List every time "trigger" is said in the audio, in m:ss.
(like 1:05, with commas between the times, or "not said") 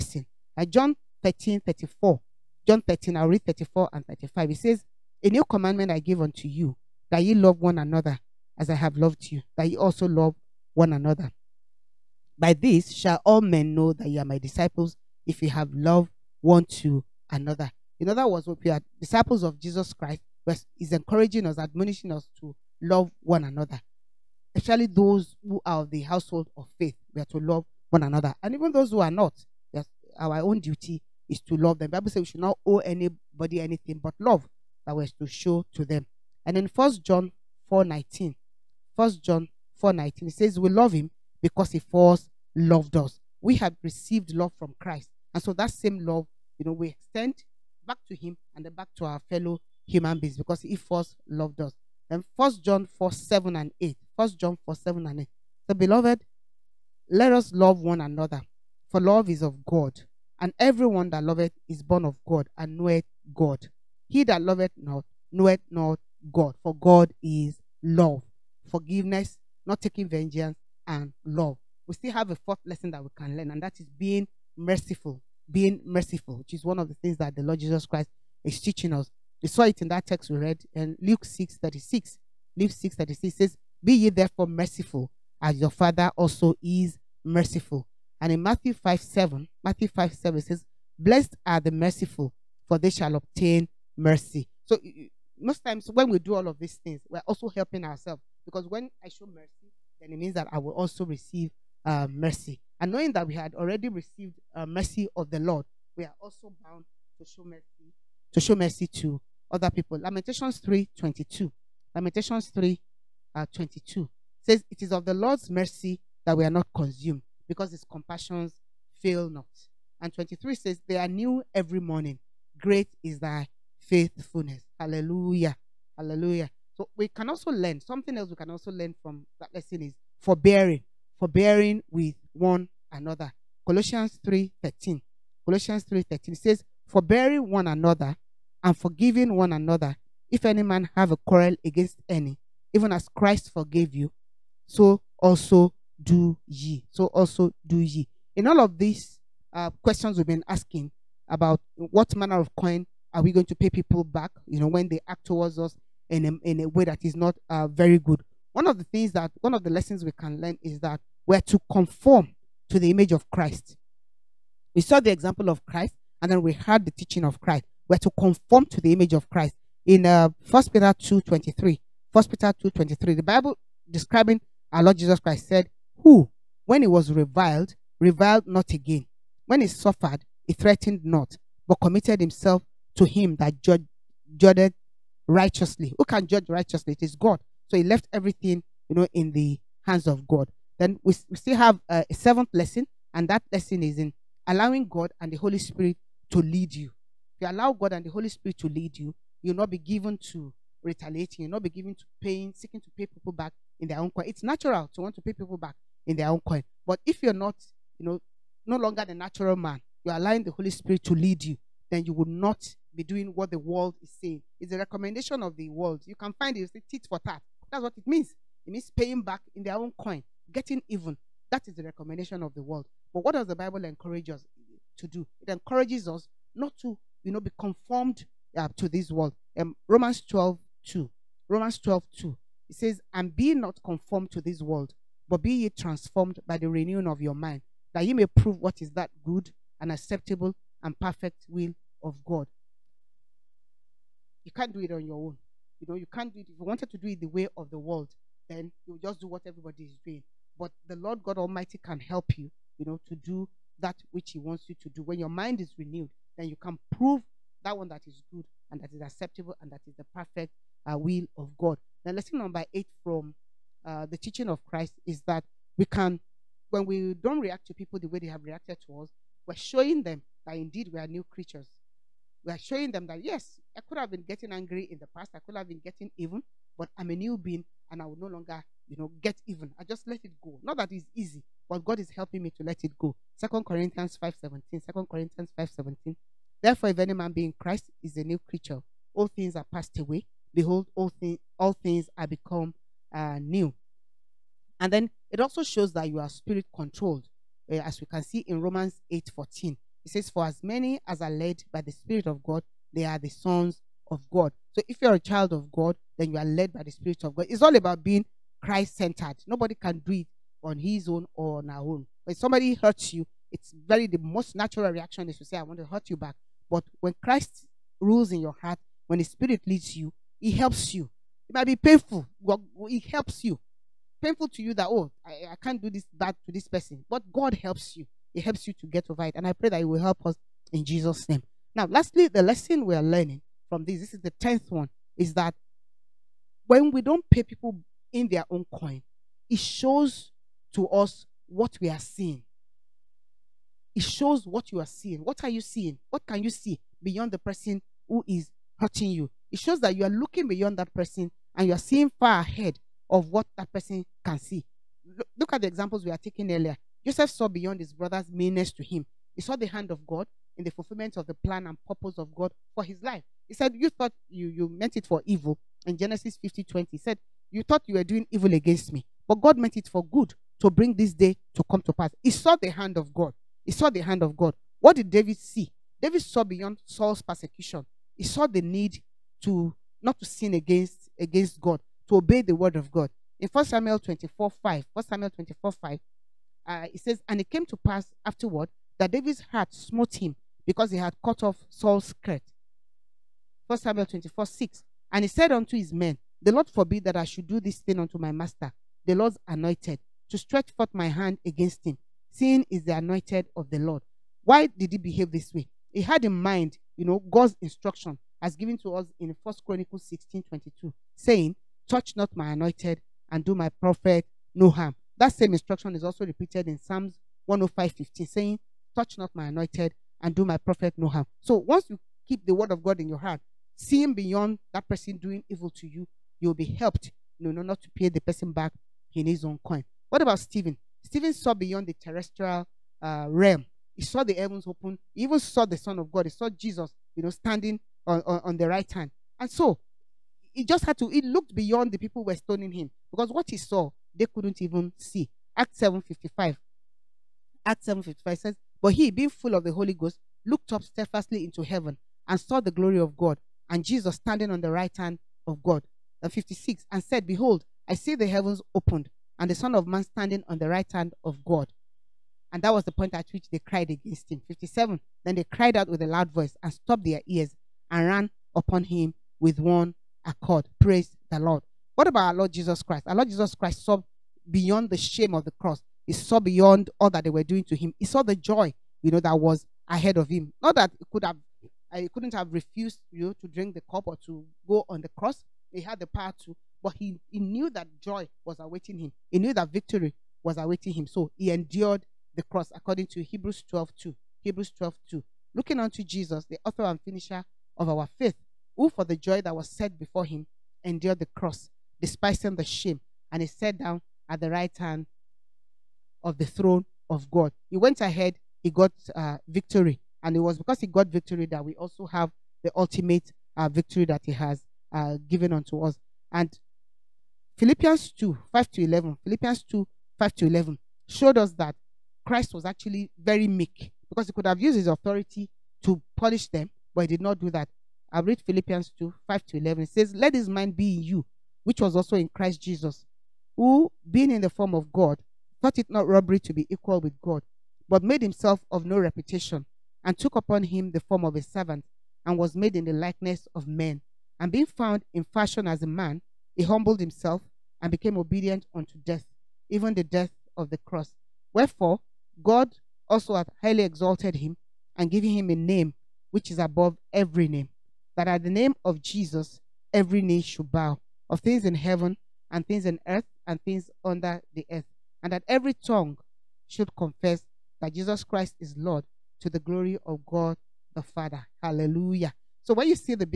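not said.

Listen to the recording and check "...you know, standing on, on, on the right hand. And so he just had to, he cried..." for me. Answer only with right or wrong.
wrong.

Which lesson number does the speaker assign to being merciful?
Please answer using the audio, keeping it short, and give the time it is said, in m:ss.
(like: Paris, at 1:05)
fourth, at 1:12.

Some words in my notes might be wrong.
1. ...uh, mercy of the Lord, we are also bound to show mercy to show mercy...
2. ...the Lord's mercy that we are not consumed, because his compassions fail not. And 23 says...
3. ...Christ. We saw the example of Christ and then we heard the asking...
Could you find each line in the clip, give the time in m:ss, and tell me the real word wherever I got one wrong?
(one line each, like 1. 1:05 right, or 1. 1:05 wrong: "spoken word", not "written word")
1. 1:44 right
2. 1:55 right
3. 2:43 wrong: "teaching", not "asking".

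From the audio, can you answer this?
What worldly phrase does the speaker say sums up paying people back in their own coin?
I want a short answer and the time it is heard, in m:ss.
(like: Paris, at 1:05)
tit for tat, at 3:36.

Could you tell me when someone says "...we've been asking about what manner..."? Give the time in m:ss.
2:30.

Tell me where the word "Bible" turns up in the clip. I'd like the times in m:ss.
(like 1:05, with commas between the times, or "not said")
0:31, 2:53, 3:43.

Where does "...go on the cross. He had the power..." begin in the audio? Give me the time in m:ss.
8:04.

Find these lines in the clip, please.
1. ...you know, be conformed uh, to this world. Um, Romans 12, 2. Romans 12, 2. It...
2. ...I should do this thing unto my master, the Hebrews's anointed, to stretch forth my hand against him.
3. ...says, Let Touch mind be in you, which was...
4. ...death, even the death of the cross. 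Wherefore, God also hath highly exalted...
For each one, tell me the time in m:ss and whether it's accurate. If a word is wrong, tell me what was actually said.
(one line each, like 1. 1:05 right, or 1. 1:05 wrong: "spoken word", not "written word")
1. 3:47 right
2. 6:37 wrong: "Lord", not "Hebrews"
3. 8:49 wrong: "His", not "Touch"
4. 9:08 right.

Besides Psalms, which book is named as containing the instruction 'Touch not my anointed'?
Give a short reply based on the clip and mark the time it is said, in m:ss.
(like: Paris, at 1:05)
First Chronicles, at 6:49.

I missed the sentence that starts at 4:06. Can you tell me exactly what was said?
If you wanted to do it the way of the world, then you just do what everybody is doing.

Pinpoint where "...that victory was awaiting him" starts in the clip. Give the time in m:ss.
8:09.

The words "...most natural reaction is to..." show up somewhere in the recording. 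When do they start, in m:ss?
5:14.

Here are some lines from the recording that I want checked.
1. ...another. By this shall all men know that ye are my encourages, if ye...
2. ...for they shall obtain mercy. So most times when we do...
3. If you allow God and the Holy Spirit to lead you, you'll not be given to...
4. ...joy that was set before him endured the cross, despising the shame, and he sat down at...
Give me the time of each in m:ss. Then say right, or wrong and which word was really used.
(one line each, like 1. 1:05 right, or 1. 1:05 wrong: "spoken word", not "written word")
1. 0:10 wrong: "disciples", not "encourages"
2. 1:32 right
3. 3:17 right
4. 8:19 right.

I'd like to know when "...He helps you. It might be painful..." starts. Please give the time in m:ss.
5:20.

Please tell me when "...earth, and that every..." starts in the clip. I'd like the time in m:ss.
9:24.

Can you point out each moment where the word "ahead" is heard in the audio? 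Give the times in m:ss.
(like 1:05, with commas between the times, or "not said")
5:52, 7:59, 8:27.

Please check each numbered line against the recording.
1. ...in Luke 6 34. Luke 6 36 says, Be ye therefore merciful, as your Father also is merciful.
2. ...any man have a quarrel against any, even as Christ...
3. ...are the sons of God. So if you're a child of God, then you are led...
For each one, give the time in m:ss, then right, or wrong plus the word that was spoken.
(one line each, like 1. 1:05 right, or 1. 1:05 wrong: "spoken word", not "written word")
1. 1:20 wrong: "36", not "34"
2. 2:20 right
3. 5:03 right.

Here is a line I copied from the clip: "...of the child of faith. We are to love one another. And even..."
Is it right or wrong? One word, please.
wrong.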